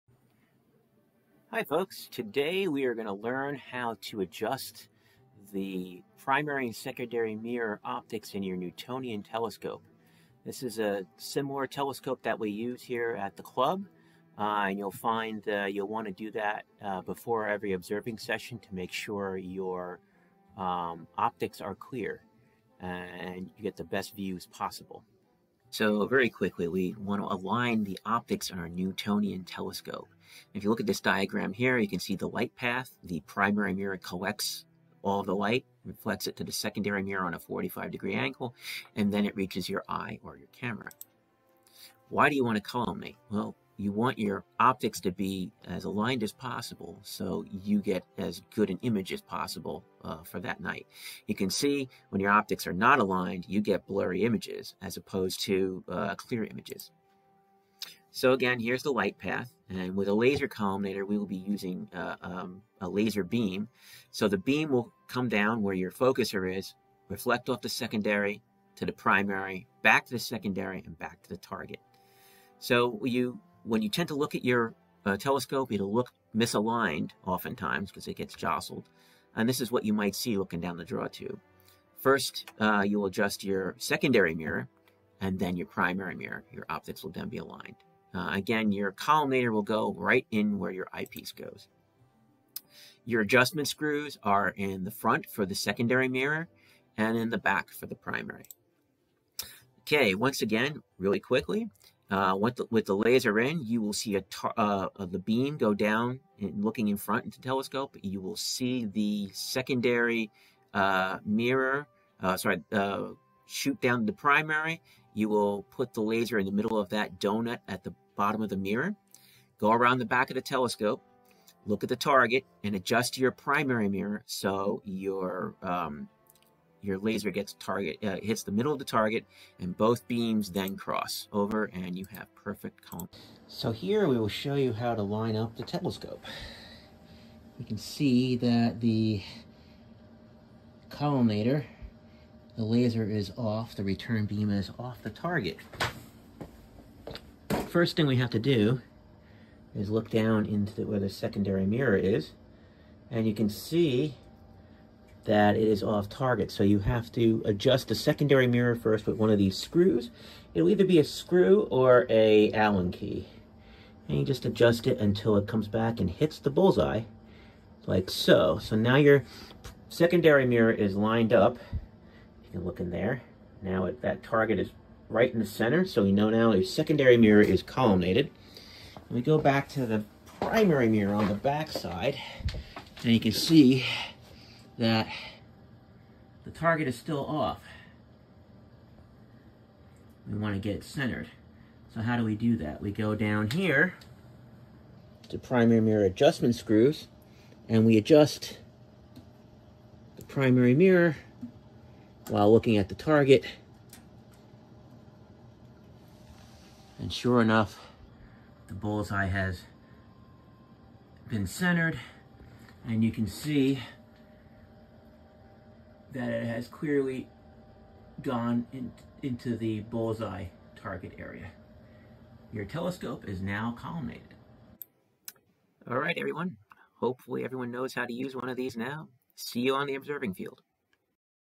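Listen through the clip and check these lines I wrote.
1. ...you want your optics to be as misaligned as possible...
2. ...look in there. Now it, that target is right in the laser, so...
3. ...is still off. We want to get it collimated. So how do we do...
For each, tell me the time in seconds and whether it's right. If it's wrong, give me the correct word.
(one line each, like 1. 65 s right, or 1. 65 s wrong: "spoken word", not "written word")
1. 43 s wrong: "aligned", not "misaligned"
2. 172 s wrong: "center", not "laser"
3. 186 s wrong: "centered", not "collimated".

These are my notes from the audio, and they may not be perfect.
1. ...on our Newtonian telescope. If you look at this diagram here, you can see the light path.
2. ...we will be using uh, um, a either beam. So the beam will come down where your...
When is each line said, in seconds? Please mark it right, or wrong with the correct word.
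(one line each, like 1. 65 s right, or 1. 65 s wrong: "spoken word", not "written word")
1. 28 s right
2. 61 s wrong: "laser", not "either".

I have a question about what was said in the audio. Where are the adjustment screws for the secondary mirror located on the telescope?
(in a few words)
In the front.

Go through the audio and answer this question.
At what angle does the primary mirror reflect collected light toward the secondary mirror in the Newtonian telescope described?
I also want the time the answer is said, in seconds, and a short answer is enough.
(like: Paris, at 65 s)
45 degrees, at 37 s.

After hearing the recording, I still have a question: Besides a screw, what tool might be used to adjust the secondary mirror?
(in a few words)
Allen key.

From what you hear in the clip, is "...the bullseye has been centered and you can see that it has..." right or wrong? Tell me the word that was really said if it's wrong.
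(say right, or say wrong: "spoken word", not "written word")
right.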